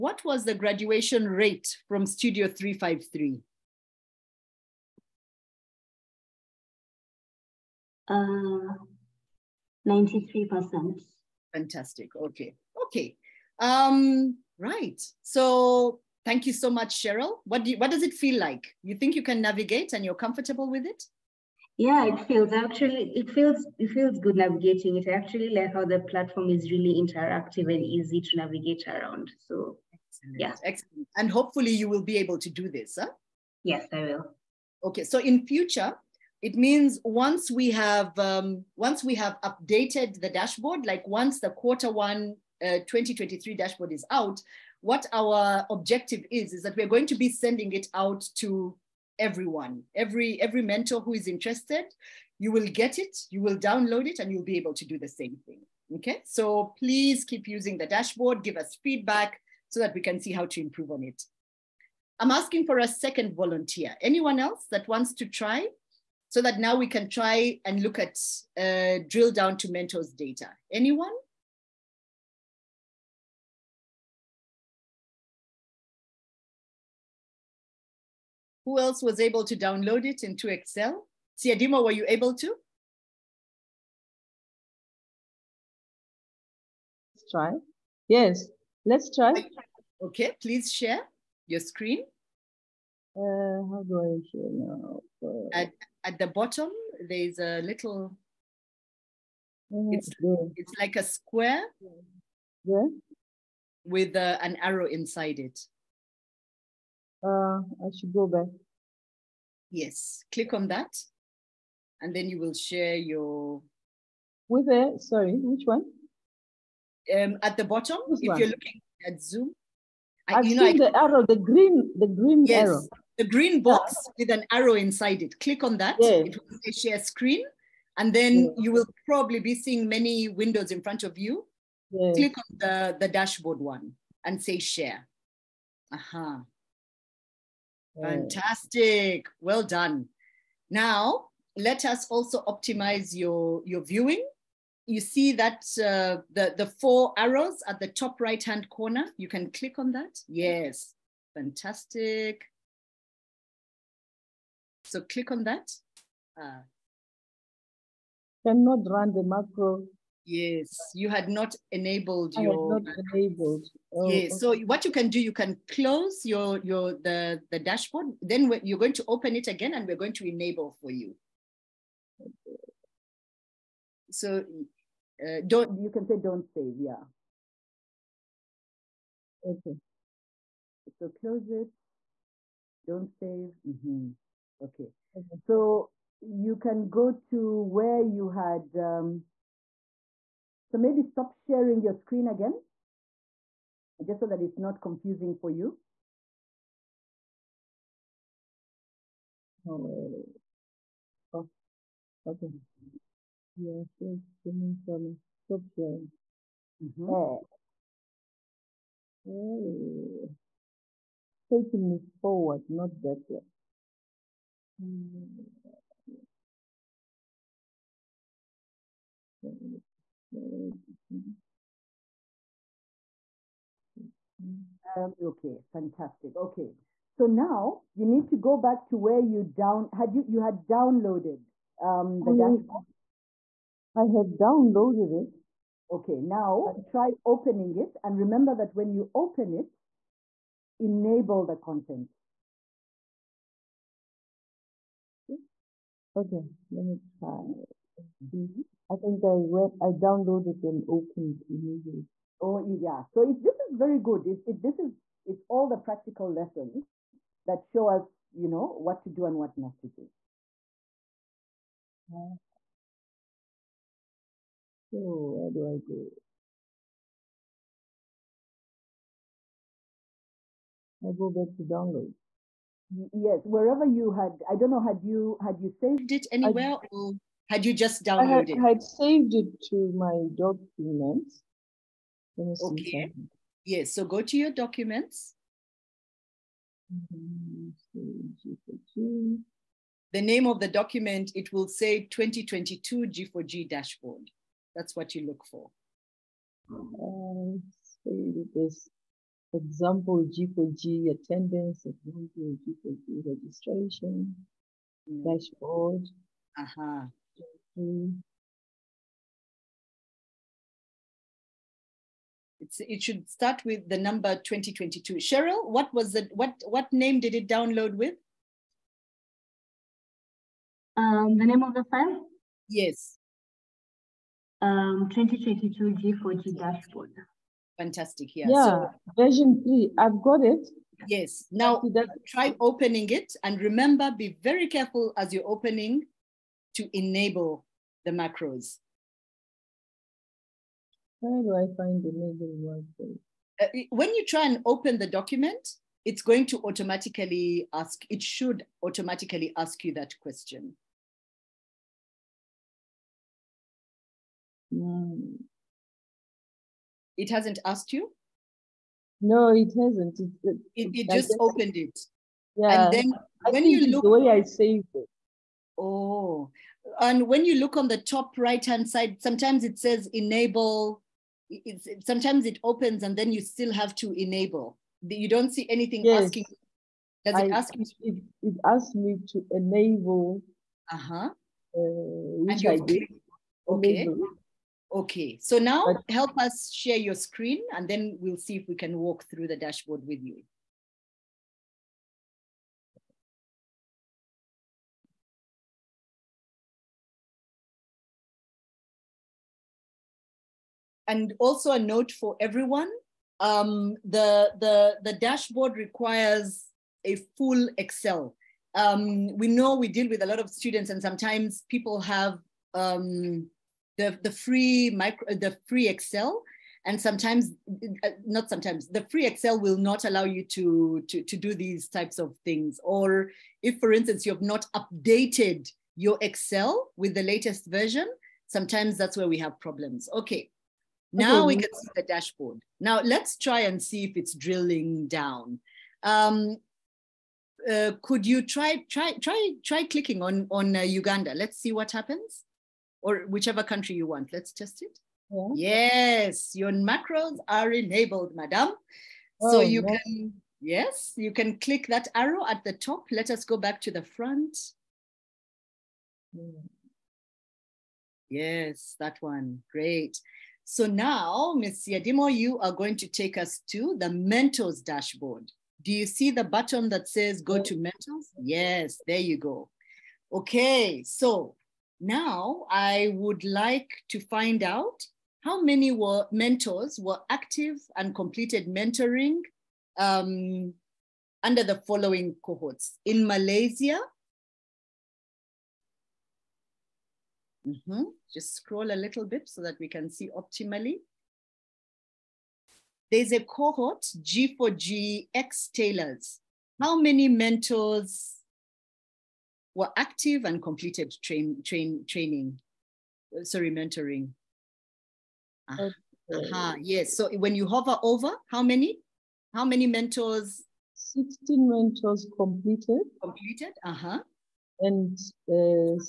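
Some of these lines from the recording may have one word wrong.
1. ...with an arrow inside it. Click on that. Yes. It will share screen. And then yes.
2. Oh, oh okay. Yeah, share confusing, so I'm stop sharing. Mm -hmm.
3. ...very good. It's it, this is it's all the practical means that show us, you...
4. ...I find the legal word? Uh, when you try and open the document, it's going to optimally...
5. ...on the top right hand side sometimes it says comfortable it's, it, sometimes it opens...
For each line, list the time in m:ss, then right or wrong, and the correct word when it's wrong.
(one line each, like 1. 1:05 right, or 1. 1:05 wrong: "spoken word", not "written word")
1. 2:04 right
2. 3:19 wrong: "streaming", not "confusing"
3. 4:13 wrong: "lessons", not "means"
4. 5:41 wrong: "automatically", not "optimally"
5. 6:07 wrong: "enable", not "comfortable".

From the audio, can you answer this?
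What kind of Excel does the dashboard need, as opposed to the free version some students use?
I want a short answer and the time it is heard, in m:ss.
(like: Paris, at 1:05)
Full Excel, at 6:47.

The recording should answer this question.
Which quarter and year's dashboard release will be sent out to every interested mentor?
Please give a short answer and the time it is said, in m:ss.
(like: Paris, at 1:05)
Quarter one 2023, at 0:41.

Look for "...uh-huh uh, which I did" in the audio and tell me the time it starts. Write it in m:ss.
6:20.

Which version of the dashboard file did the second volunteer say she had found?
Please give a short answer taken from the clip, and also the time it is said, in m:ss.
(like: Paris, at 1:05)
Version three, at 5:29.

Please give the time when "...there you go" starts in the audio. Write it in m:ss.
7:49.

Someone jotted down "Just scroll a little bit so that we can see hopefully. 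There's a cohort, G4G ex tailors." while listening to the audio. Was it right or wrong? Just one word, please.
wrong.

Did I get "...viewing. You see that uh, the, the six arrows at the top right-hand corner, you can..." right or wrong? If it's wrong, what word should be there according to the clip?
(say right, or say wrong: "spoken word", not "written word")
wrong: "four", not "six".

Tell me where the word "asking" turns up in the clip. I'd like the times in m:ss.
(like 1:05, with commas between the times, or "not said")
1:02, 6:16.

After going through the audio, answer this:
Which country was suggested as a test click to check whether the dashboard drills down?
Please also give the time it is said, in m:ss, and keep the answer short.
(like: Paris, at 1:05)
Uganda, at 7:20.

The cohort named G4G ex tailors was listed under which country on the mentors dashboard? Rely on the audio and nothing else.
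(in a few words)
Malaysia.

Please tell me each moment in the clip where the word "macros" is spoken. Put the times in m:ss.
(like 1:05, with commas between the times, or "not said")
2:39, 5:38, 7:26.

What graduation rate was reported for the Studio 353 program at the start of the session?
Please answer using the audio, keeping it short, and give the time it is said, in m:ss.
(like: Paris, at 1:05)
93%, at 0:09.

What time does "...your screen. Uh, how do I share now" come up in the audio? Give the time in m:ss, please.
1:31.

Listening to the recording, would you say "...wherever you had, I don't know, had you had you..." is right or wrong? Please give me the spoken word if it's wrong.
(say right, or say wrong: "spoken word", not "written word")
right.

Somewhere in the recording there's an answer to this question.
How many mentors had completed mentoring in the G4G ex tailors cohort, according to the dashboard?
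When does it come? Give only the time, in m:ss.
8:30.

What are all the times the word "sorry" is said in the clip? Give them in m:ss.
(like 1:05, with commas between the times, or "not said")
1:55, 8:23.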